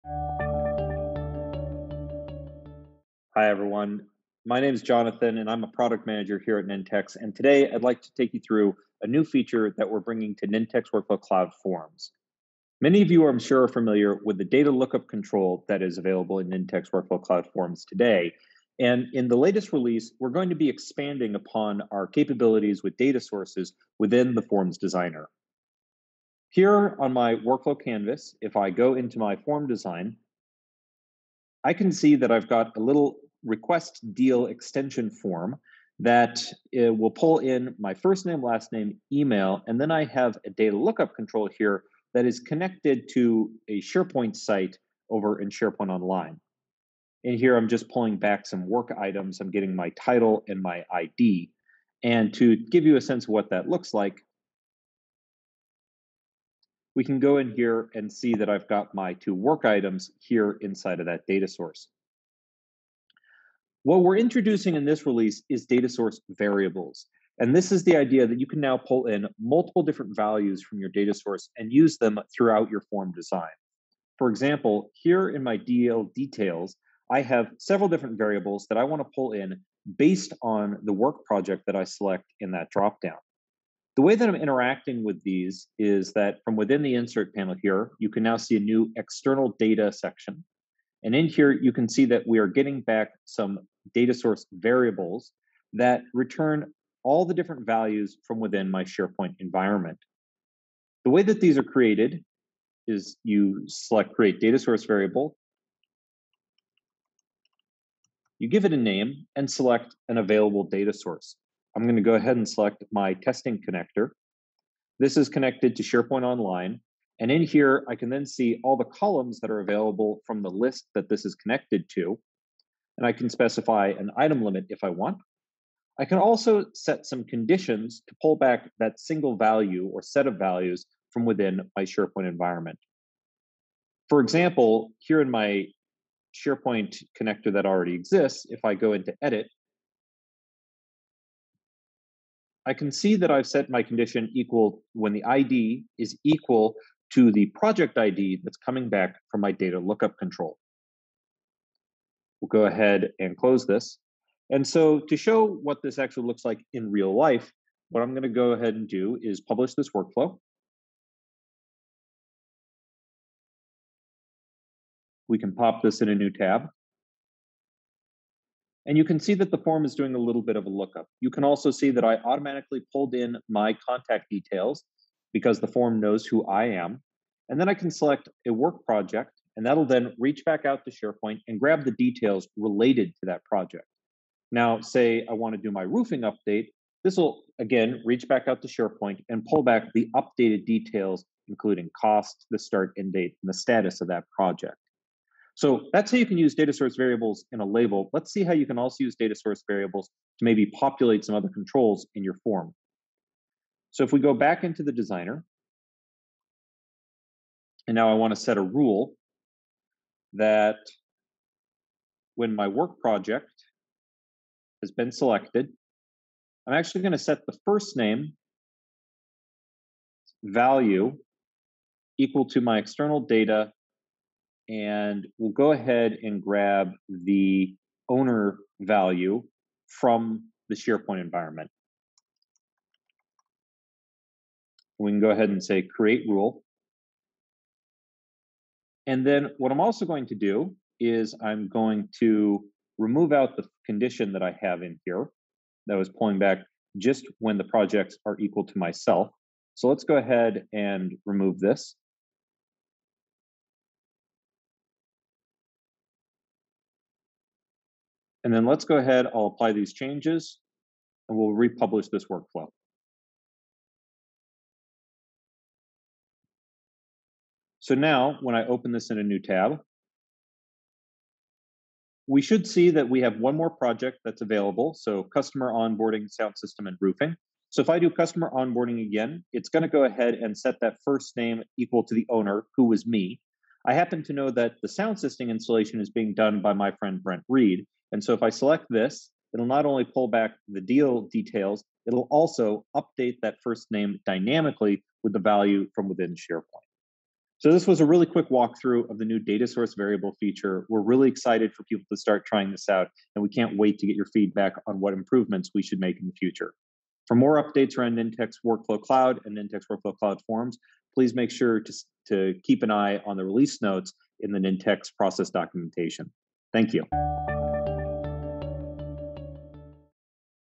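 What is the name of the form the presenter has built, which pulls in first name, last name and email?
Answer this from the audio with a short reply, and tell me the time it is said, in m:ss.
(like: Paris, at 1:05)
Request deal extension form, at 0:33.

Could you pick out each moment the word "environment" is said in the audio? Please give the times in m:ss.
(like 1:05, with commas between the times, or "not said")
1:39, 2:12, 3:51.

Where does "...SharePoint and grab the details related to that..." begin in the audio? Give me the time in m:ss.
3:00.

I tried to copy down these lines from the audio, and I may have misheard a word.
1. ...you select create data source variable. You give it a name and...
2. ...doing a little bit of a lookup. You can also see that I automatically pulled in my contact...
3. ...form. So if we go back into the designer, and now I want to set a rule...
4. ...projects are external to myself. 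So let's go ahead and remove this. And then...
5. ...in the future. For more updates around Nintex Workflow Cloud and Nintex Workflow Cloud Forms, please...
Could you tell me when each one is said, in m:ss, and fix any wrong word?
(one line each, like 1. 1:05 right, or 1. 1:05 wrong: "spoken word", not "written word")
1. 1:43 right
2. 2:49 right
3. 3:22 right
4. 4:07 wrong: "equal", not "external"
5. 5:06 right.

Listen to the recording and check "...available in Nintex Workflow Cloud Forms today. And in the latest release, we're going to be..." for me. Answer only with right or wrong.
right.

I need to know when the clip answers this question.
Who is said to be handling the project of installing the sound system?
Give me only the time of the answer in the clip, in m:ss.
4:47.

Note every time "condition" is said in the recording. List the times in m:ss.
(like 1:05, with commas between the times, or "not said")
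2:07, 2:23, 4:03.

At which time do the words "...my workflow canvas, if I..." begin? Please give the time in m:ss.
0:27.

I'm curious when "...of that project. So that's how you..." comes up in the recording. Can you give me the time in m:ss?
3:14.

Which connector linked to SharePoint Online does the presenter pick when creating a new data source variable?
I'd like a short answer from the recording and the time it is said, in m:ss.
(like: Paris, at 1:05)
Testing connector, at 1:53.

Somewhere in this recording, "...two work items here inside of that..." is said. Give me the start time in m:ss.
0:59.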